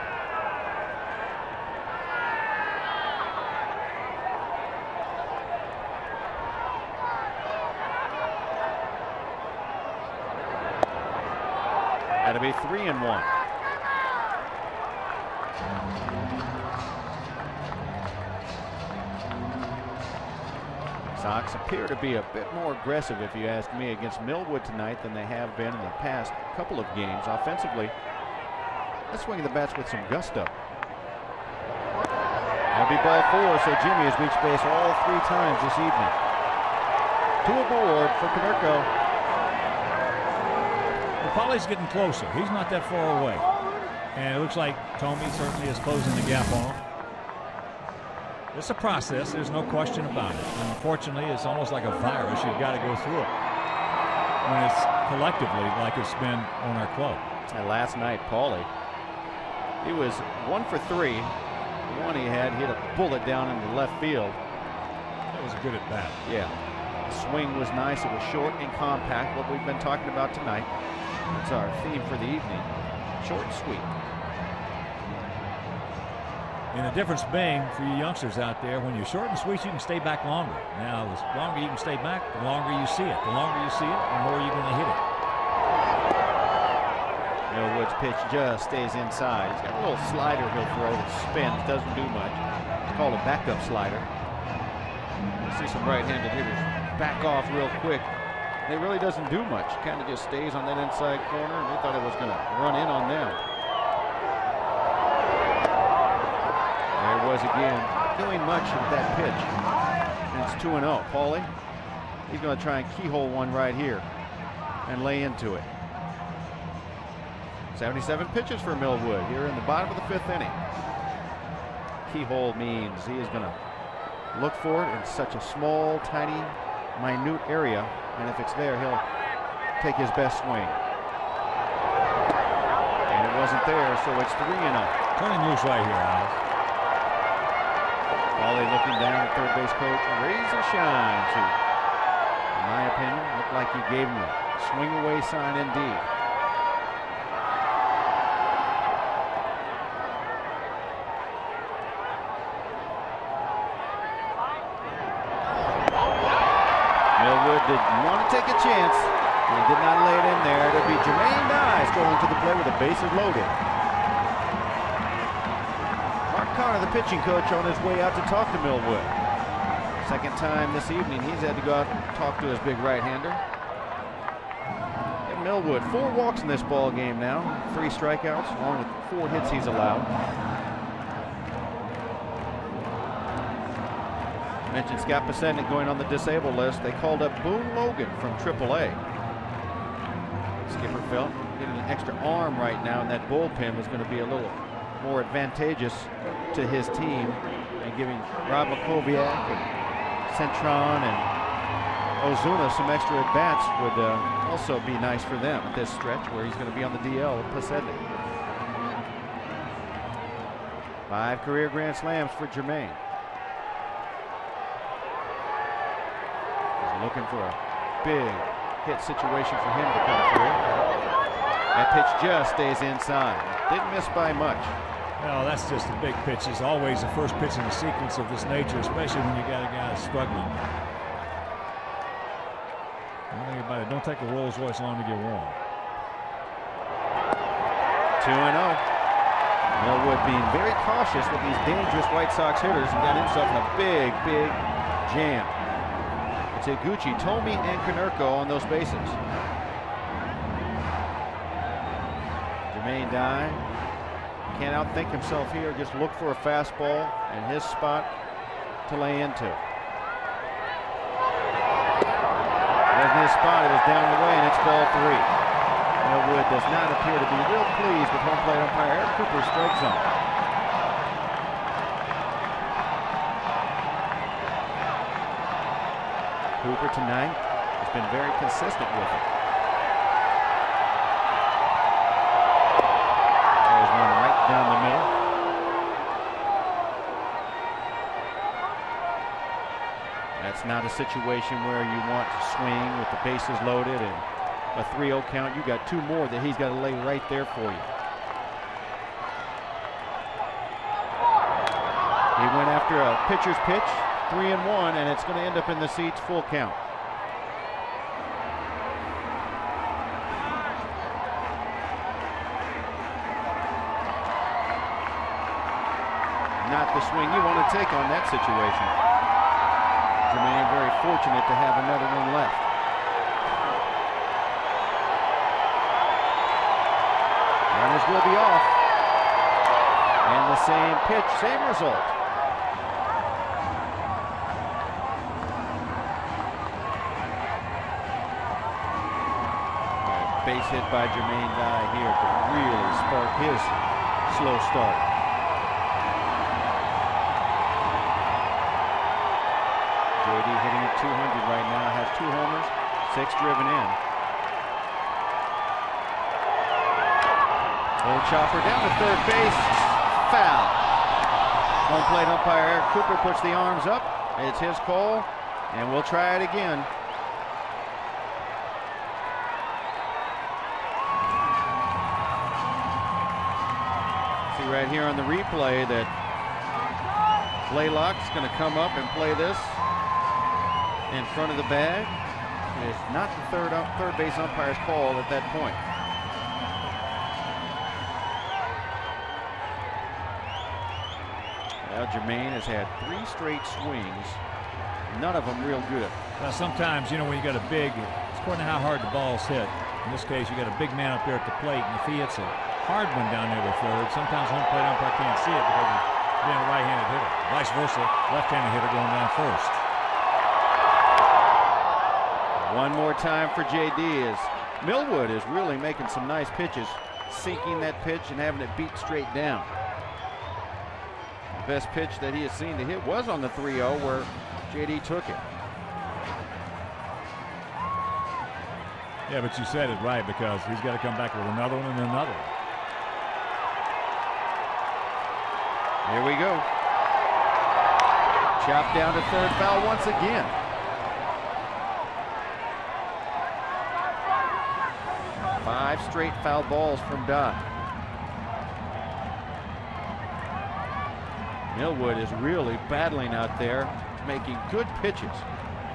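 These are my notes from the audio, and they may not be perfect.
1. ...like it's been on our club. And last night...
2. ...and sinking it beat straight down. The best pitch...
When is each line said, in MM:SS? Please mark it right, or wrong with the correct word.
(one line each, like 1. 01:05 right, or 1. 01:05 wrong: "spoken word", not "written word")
1. 00:55 right
2. 06:58 wrong: "having", not "sinking".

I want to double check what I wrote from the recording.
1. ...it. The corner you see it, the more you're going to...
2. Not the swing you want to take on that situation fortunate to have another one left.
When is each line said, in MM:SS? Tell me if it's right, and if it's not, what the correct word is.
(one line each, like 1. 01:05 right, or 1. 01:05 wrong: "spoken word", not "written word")
1. 01:23 wrong: "longer", not "corner"
2. 05:16 right.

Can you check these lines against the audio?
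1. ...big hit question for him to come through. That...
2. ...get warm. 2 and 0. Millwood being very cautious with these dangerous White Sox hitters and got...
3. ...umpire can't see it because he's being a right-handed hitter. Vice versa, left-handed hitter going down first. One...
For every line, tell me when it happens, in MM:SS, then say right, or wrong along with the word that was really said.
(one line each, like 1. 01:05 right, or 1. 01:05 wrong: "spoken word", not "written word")
1. 03:38 wrong: "situation", not "question"
2. 03:55 right
3. 06:44 right.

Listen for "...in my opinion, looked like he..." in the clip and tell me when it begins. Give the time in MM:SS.
02:22.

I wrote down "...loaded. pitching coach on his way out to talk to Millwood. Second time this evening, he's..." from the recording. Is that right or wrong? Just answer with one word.
right.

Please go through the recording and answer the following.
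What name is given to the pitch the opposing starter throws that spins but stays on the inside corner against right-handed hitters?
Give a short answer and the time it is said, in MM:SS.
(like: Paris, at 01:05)
backup slider, at 01:33.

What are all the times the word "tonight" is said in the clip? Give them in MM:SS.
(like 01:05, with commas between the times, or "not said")
00:24, 01:10, 04:36.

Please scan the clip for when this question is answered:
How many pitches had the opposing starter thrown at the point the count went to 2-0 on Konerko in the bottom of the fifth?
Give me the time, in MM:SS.
01:57.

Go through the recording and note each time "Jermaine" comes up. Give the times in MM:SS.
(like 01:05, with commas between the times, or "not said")
02:41, 03:32, 04:12, 05:41, 06:32.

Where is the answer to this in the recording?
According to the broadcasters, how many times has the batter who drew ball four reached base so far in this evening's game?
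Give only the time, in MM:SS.
00:35.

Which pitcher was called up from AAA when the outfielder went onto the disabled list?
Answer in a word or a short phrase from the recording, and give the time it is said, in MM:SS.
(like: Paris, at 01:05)
Boone Logan, at 03:07.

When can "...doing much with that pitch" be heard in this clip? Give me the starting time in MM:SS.
01:48.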